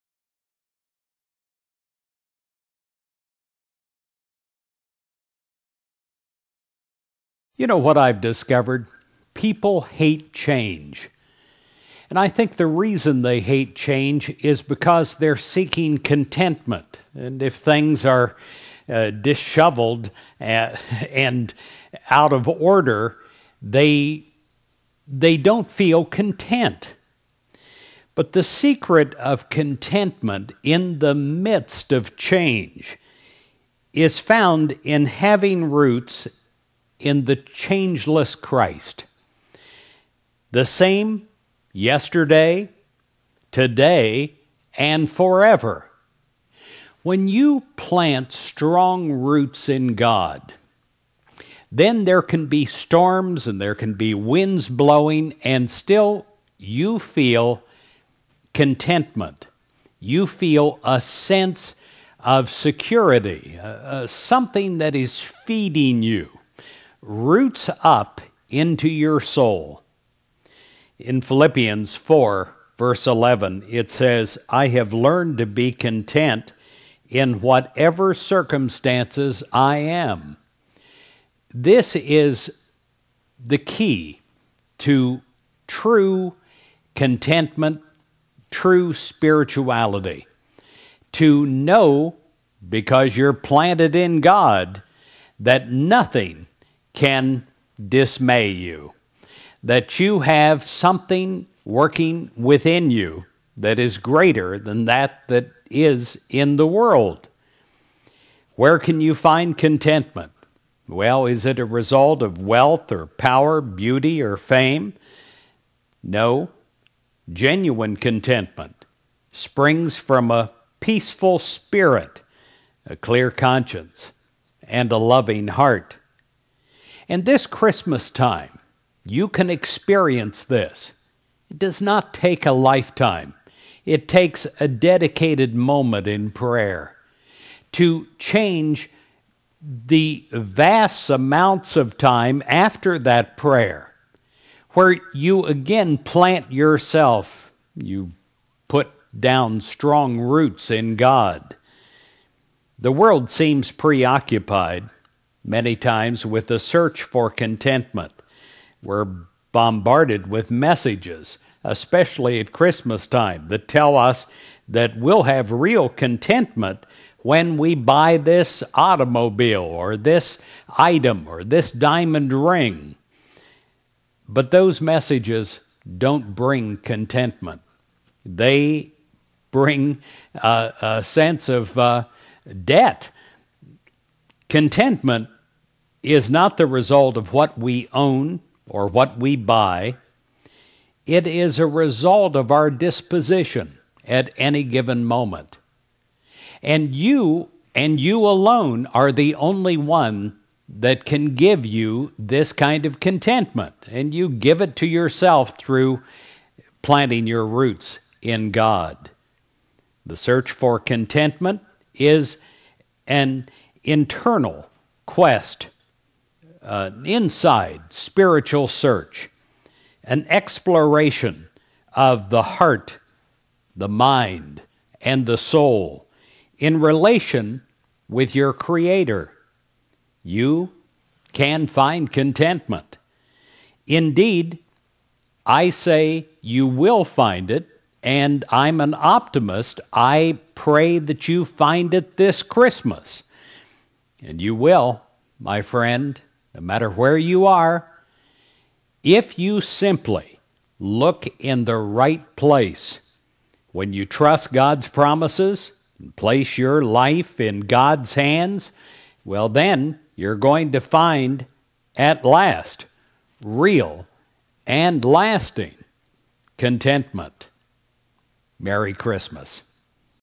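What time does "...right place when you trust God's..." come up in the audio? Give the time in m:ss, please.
4:11.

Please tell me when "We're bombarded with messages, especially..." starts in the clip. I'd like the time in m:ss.
2:38.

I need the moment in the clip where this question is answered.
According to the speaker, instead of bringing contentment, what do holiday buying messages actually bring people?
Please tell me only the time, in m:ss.
3:02.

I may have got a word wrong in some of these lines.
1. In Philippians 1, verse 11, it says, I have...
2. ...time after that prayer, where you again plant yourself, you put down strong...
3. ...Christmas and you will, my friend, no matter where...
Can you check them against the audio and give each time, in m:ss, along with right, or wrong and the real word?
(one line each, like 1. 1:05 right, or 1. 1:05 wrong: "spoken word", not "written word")
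1. 1:10 wrong: "4", not "1"
2. 2:21 right
3. 4:02 right.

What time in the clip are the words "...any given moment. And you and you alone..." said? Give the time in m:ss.
3:14.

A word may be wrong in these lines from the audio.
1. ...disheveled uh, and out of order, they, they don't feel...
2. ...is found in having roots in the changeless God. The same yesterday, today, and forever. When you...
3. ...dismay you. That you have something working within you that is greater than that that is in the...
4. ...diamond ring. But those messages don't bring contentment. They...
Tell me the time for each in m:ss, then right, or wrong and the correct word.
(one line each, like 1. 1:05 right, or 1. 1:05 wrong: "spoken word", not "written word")
1. 0:19 right
2. 0:33 wrong: "Christ", not "God"
3. 1:37 right
4. 2:51 right.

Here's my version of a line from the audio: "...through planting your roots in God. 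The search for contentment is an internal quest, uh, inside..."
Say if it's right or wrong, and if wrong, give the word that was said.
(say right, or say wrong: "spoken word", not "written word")
right.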